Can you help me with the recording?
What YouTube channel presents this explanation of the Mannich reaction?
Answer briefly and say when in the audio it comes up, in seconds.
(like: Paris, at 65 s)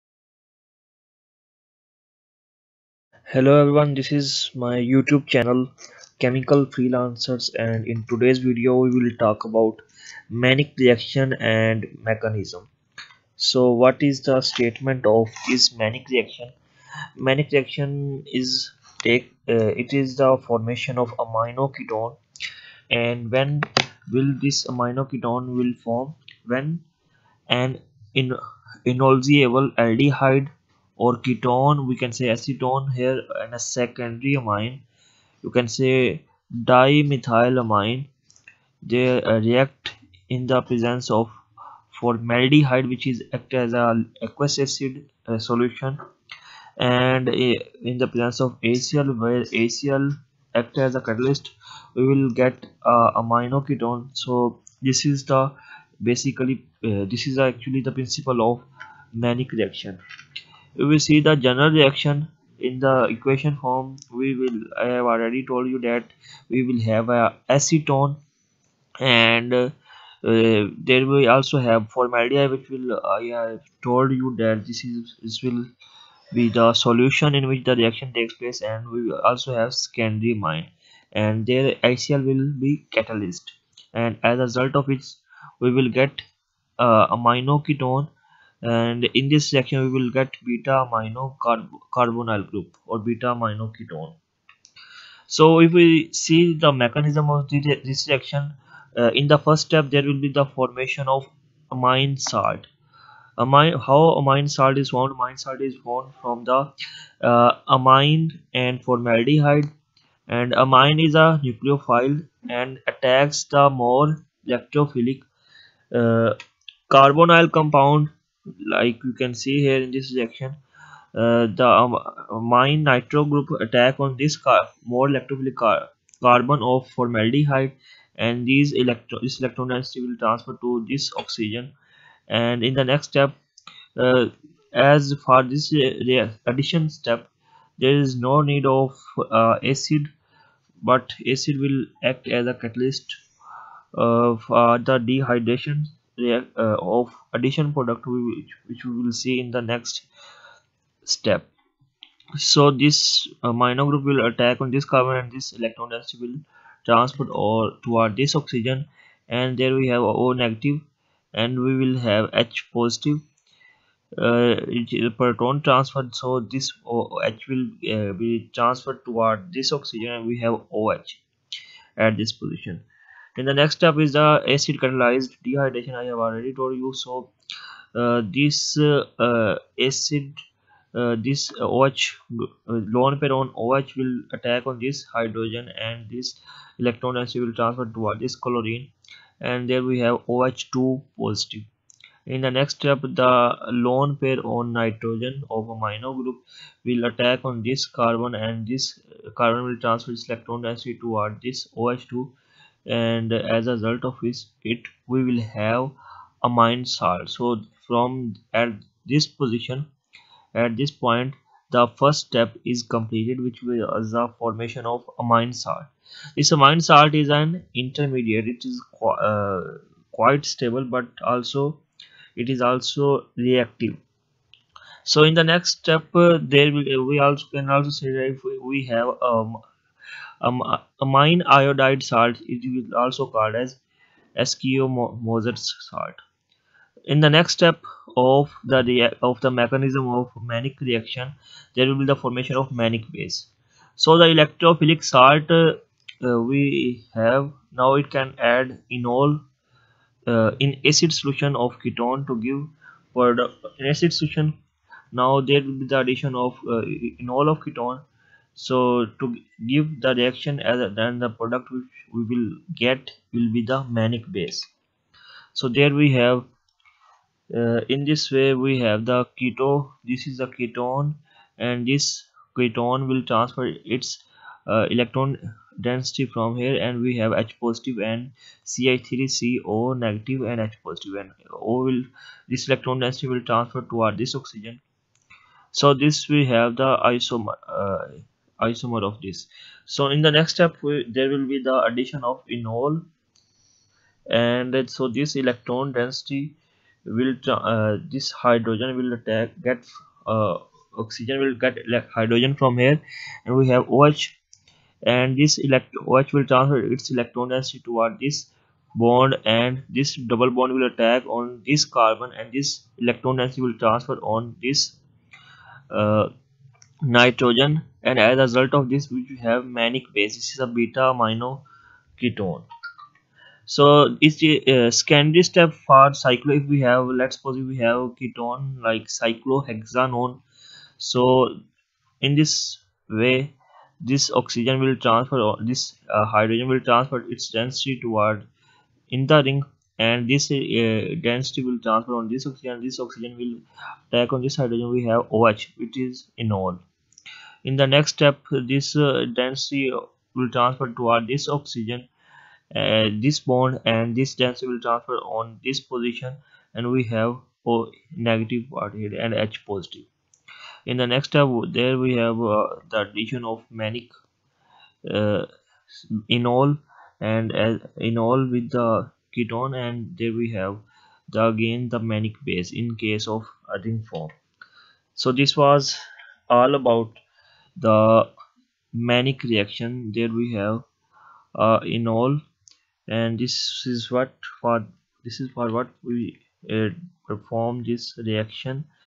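Chemical Freelancers, at 6 s.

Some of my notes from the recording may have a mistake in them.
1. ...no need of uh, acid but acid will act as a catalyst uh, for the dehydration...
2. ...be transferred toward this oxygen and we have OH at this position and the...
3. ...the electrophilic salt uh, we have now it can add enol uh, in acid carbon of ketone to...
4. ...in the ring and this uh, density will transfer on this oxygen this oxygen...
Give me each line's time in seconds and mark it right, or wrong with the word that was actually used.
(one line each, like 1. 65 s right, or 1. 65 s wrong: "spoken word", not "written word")
1. 138 s right
2. 168 s right
3. 244 s wrong: "solution", not "carbon"
4. 339 s right.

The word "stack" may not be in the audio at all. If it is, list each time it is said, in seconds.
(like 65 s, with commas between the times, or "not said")
not said.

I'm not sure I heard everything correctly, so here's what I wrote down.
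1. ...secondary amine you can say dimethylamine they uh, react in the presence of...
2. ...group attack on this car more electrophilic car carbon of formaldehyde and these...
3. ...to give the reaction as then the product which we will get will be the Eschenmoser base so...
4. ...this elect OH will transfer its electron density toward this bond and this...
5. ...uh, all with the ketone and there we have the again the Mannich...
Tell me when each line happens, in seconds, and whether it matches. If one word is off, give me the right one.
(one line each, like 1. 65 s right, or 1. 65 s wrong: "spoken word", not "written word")
1. 33 s right
2. 123 s right
3. 259 s wrong: "Mannich", not "Eschenmoser"
4. 305 s right
5. 367 s right.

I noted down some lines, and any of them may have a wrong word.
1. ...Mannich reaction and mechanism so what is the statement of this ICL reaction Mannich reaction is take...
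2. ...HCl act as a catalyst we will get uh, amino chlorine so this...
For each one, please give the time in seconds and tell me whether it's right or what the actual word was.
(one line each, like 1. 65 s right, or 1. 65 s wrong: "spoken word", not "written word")
1. 10 s wrong: "Mannich", not "ICL"
2. 49 s wrong: "ketone", not "chlorine".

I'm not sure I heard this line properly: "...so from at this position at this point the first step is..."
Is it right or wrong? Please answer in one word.
right.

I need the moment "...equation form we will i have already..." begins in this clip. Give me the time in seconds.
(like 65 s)
63 s.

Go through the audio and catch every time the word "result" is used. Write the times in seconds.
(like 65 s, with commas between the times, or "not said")
84 s, 203 s, 318 s.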